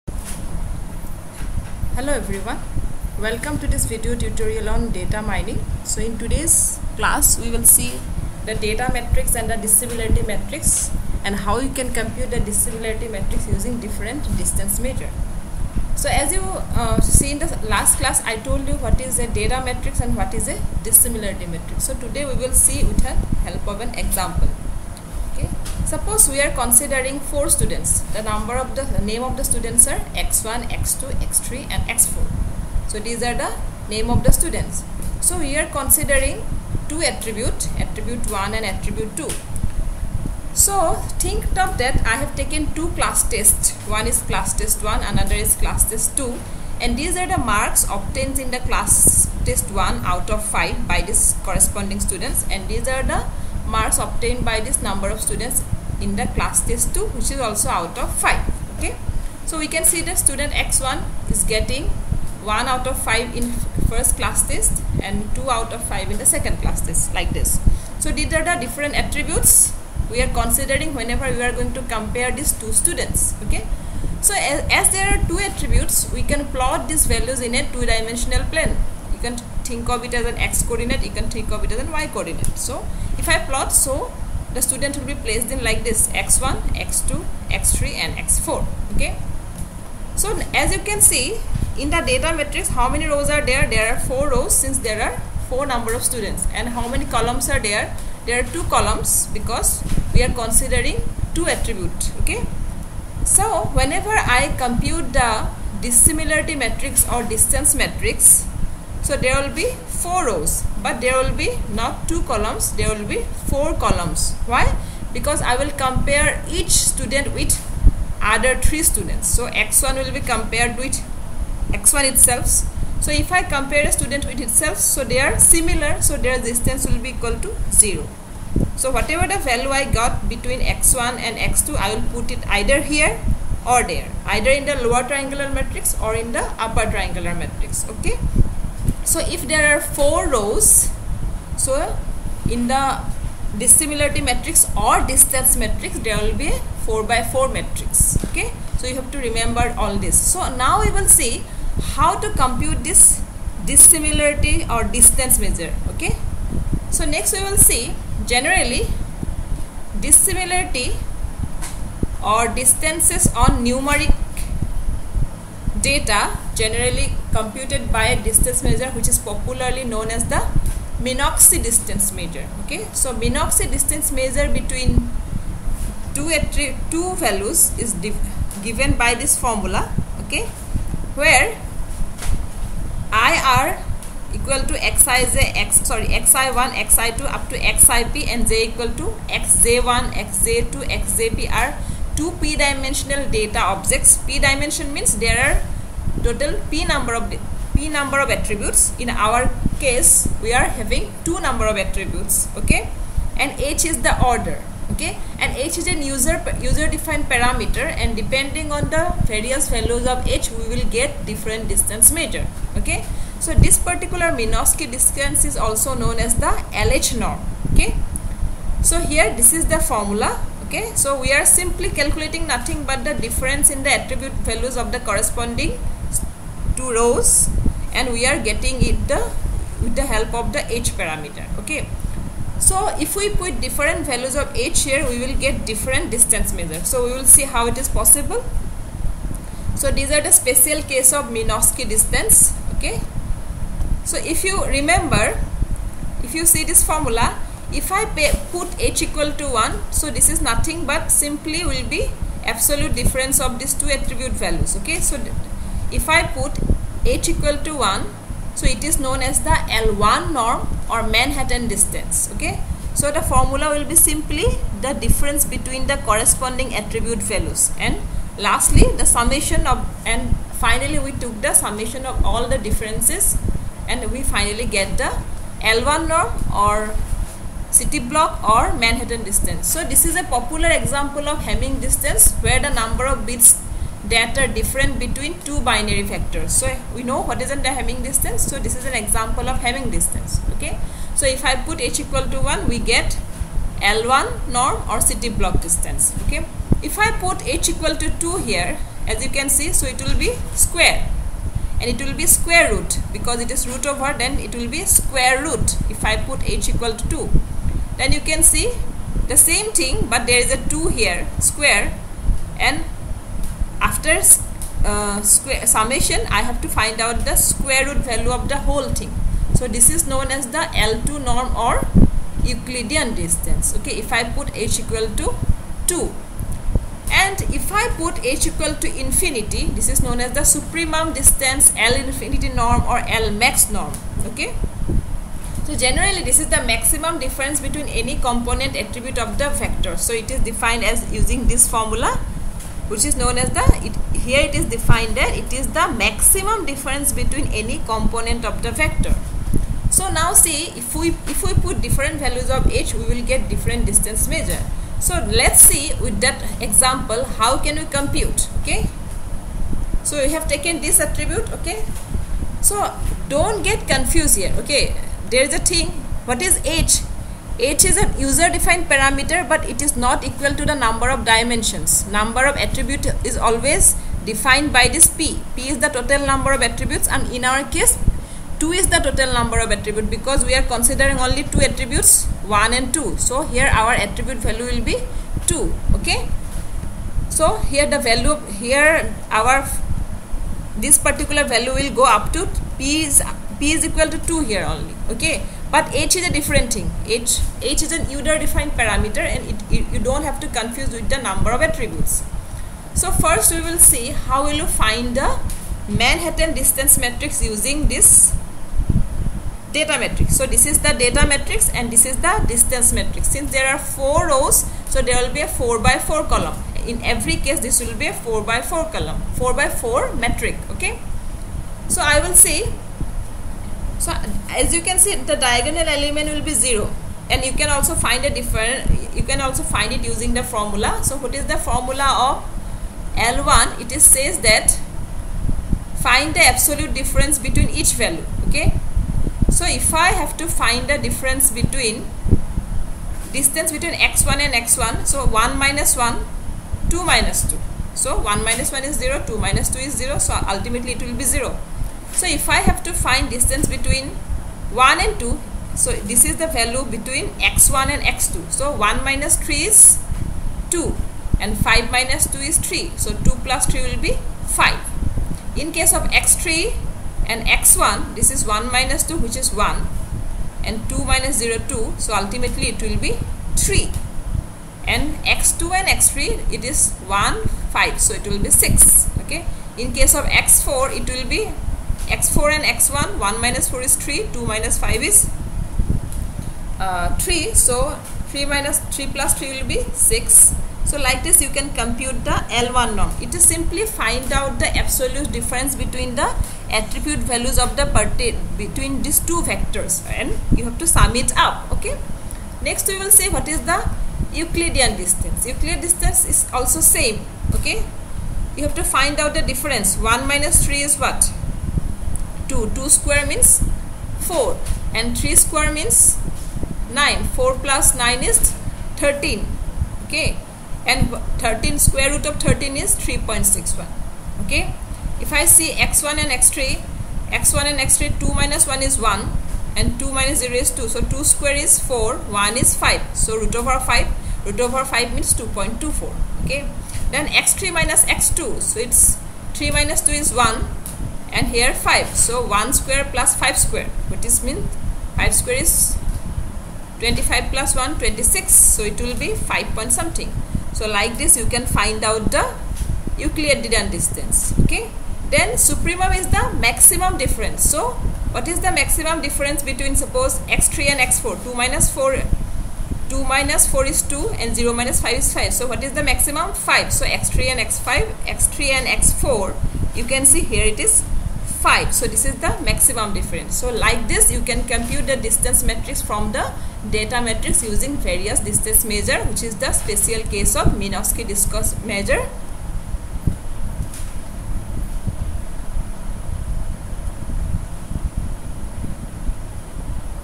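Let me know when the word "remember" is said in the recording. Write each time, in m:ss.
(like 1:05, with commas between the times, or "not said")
2:29, 4:04.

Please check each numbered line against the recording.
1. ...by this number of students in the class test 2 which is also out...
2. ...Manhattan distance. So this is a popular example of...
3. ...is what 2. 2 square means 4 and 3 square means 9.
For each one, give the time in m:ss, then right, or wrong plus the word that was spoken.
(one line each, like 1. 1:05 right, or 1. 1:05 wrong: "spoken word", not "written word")
1. 0:54 right
2. 4:38 right
3. 8:30 right.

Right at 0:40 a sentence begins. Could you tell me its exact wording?
So think of that I have taken two class tests.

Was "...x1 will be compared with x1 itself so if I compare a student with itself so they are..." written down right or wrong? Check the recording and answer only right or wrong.
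right.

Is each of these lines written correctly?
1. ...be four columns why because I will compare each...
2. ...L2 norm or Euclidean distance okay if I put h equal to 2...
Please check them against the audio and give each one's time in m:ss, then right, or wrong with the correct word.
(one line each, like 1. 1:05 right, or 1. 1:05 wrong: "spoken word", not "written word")
1. 1:53 right
2. 5:20 right.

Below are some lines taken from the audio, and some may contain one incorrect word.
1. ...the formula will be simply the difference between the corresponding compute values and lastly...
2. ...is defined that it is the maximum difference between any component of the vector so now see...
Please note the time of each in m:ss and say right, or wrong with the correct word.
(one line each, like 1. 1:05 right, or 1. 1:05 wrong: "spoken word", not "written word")
1. 4:23 wrong: "attribute", not "compute"
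2. 5:44 right.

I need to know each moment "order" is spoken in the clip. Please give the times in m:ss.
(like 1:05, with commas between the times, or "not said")
3:24.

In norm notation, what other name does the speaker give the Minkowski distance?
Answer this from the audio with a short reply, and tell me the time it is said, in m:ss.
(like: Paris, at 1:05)
LH norm, at 3:36.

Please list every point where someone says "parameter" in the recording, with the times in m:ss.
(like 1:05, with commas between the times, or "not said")
3:27, 3:51, 6:08, 6:38.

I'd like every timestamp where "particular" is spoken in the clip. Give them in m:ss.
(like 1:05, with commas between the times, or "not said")
3:33, 6:30.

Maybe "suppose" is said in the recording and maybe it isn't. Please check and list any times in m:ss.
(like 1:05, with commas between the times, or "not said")
0:25, 9:19.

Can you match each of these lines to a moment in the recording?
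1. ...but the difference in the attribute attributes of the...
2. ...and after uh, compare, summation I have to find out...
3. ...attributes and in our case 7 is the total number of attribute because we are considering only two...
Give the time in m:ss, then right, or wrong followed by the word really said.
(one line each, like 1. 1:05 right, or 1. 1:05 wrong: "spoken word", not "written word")
1. 3:42 wrong: "values", not "attributes"
2. 5:12 wrong: "square", not "compare"
3. 6:16 wrong: "2", not "7".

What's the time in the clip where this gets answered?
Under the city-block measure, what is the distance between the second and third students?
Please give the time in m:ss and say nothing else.
7:55.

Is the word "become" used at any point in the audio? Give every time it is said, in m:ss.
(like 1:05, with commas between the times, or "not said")
not said.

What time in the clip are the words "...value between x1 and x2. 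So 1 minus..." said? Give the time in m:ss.
7:36.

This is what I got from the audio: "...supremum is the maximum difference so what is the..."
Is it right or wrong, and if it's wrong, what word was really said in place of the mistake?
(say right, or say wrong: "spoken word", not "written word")
right.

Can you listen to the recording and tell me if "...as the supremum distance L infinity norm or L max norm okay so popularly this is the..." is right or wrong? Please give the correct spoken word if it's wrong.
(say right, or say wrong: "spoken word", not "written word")
wrong: "generally", not "popularly".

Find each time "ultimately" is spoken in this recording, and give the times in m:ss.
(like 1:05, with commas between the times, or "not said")
7:30, 7:52.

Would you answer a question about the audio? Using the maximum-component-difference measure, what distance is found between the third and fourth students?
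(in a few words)
5.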